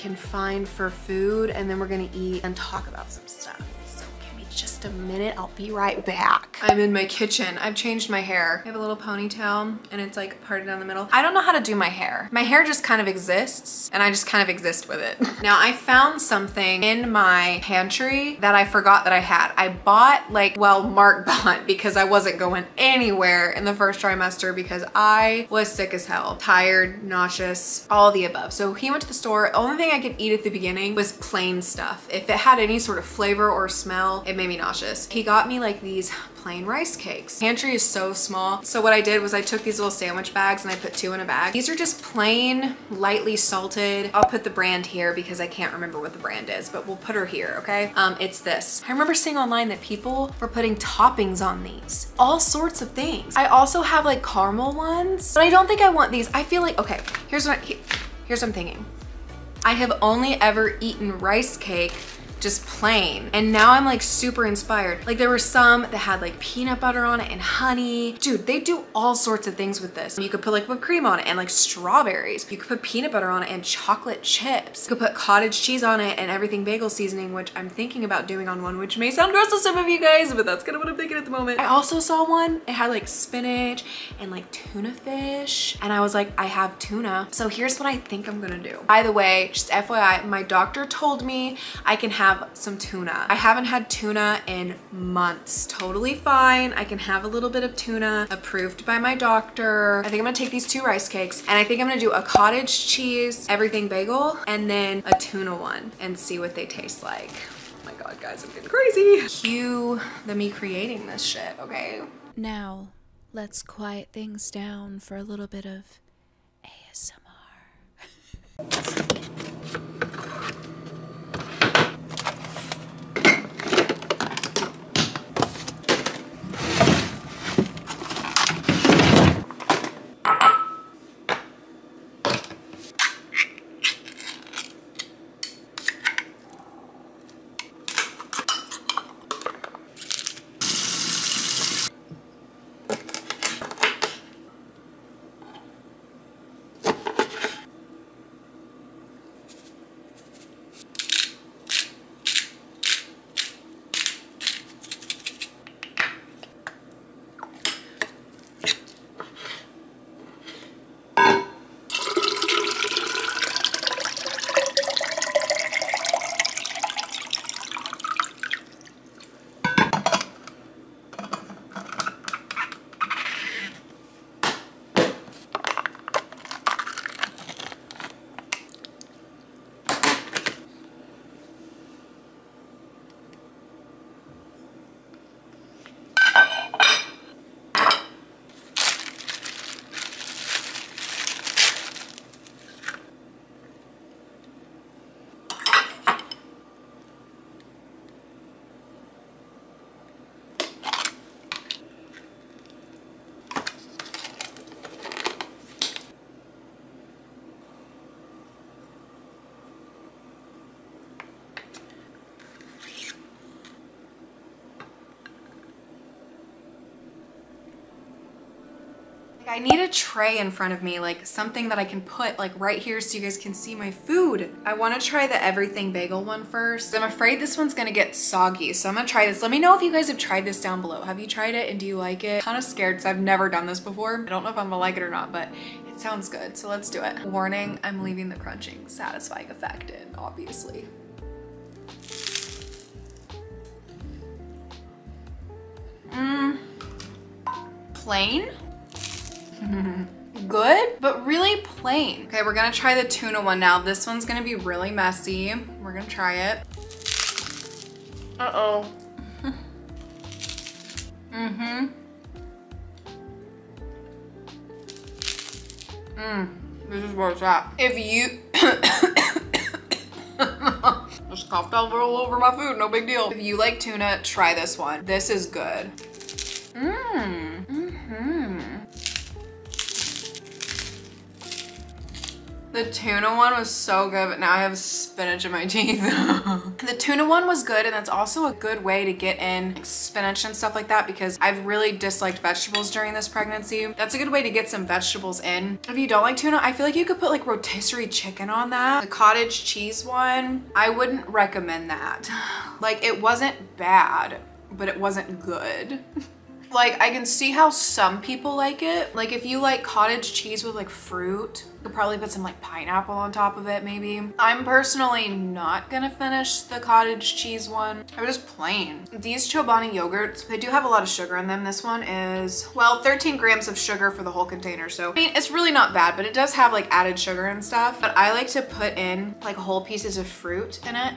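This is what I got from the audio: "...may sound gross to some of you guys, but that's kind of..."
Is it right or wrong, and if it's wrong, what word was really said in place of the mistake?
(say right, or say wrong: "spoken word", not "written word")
right.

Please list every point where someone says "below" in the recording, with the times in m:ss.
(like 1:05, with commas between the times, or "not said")
3:50.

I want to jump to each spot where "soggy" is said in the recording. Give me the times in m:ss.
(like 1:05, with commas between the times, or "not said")
3:48.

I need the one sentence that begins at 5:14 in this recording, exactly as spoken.
I'm personally not gonna finish the cottage cheese one.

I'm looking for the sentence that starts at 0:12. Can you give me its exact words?
My hair just kind of exists and I just kind of exist with it.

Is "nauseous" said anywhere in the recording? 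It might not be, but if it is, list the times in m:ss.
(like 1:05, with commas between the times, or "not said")
0:27, 0:34.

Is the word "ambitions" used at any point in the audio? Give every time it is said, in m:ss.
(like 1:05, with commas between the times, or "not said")
not said.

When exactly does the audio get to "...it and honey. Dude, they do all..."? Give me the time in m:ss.
1:07.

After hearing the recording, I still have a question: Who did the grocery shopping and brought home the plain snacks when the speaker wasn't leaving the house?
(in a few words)
Mark.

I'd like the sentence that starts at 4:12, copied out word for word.
Okay, we're gonna try the tuna one now.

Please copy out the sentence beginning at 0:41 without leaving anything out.
These are just plain, lightly salted.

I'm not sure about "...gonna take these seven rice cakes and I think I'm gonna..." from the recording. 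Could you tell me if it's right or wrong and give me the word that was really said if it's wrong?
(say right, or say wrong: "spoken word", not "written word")
wrong: "two", not "seven".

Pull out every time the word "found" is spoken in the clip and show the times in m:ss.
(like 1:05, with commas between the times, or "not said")
0:15.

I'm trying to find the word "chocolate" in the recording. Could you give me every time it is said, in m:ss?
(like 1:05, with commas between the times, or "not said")
1:13.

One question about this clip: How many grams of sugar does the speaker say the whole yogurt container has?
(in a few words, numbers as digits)
13.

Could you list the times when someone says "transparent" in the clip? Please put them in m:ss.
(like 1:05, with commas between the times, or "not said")
not said.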